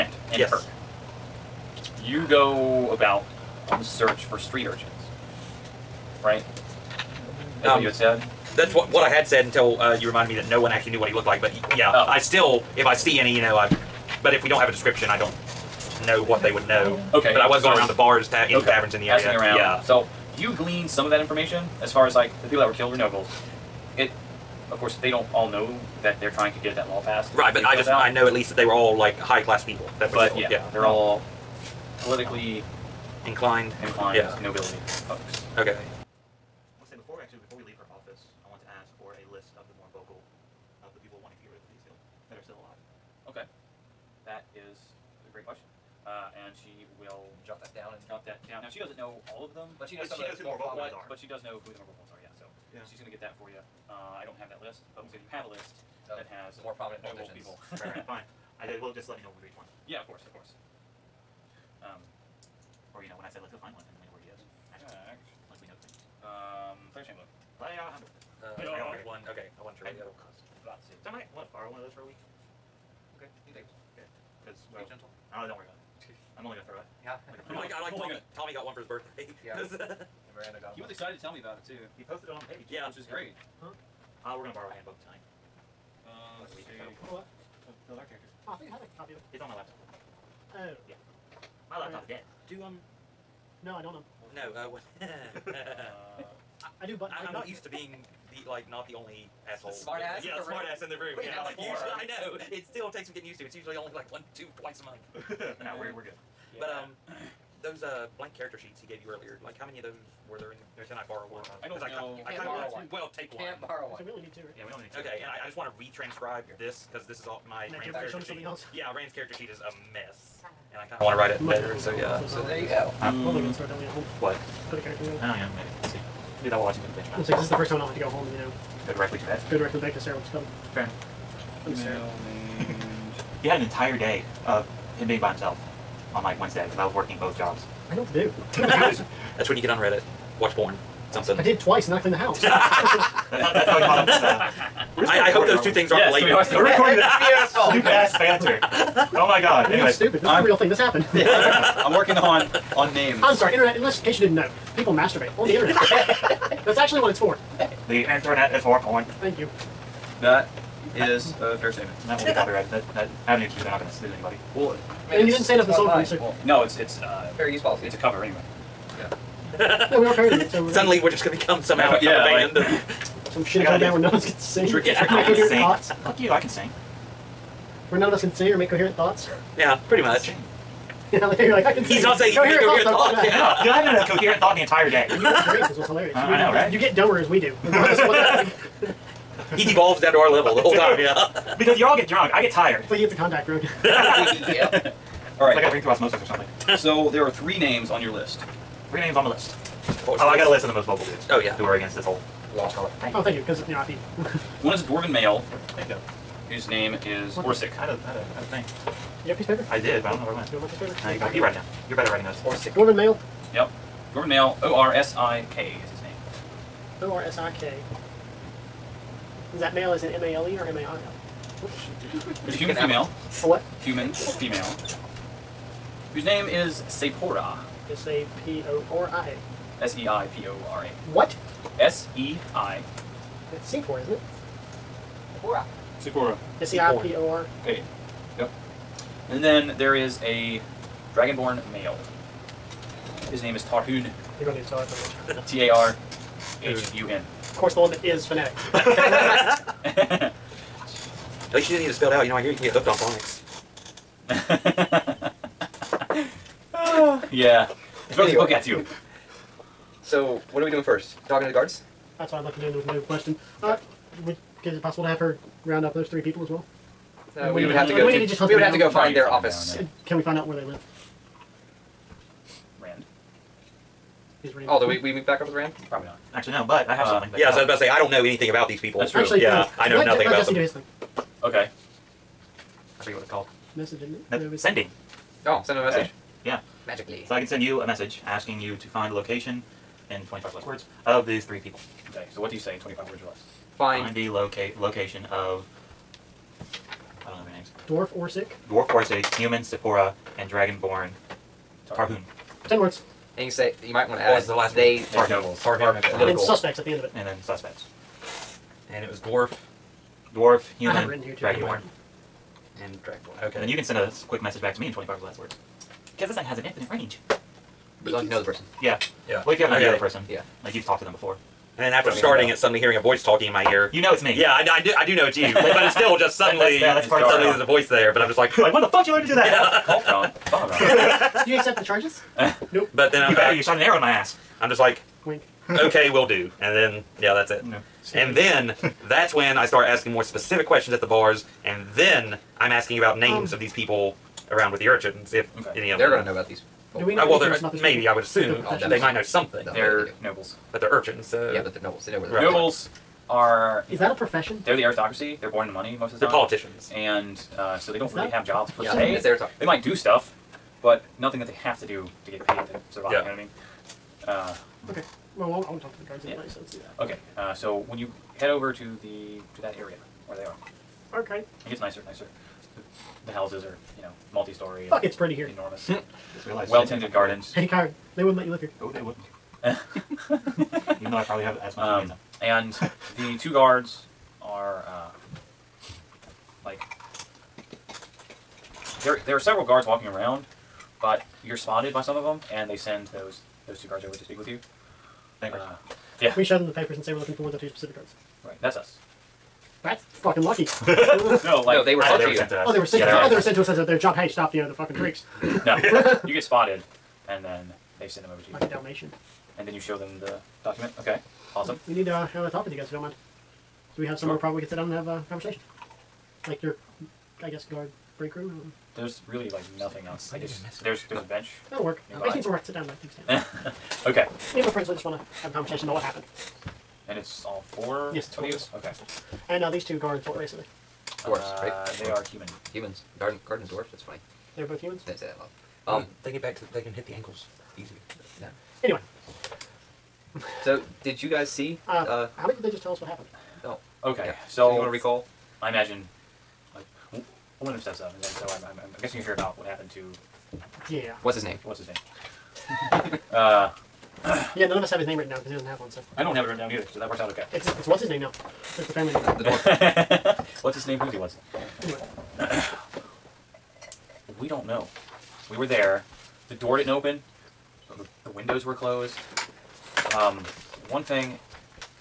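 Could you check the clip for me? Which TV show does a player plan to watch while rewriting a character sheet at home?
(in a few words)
Adventure Time.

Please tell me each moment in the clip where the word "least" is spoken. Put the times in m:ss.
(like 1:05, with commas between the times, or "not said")
0:28, 4:11.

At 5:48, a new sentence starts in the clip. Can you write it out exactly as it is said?
I would assume the they might know something.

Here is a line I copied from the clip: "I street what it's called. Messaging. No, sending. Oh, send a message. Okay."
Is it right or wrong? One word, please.
wrong.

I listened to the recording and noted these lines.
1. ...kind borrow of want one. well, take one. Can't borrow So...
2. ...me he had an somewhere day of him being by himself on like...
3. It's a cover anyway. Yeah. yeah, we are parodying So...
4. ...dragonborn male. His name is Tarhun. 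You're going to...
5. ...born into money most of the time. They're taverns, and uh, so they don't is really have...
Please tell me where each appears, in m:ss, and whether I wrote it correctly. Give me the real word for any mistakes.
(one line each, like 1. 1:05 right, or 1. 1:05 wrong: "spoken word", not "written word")
1. 1:52 right
2. 2:11 wrong: "entire", not "somewhere"
3. 2:47 right
4. 4:01 right
5. 5:55 wrong: "politicians", not "taverns".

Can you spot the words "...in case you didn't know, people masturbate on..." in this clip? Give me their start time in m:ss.
2:34.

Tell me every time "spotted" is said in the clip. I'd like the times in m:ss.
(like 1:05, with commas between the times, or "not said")
6:31, 6:46.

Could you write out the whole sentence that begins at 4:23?
Uh, would, is it possible to have her round up those three people as well?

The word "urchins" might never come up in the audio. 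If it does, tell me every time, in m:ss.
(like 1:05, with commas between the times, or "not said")
0:04, 5:44, 5:50.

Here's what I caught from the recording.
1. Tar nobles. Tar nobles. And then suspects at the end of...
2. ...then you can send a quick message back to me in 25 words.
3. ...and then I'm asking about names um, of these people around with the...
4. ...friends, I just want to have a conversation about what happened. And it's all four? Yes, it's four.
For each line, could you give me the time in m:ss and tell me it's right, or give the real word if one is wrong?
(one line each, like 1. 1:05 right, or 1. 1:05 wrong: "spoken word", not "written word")
1. 5:05 right
2. 5:13 right
3. 5:41 right
4. 7:04 right.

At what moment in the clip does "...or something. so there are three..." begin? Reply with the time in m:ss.
3:16.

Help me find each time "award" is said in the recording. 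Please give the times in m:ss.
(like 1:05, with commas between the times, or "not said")
not said.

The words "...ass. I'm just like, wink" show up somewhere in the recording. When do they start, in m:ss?
5:34.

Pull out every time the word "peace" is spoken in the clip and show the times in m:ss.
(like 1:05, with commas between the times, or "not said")
0:41.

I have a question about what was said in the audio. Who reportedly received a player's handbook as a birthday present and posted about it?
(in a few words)
Tommy.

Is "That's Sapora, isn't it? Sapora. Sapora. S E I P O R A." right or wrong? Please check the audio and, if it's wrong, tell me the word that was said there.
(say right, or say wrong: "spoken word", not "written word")
right.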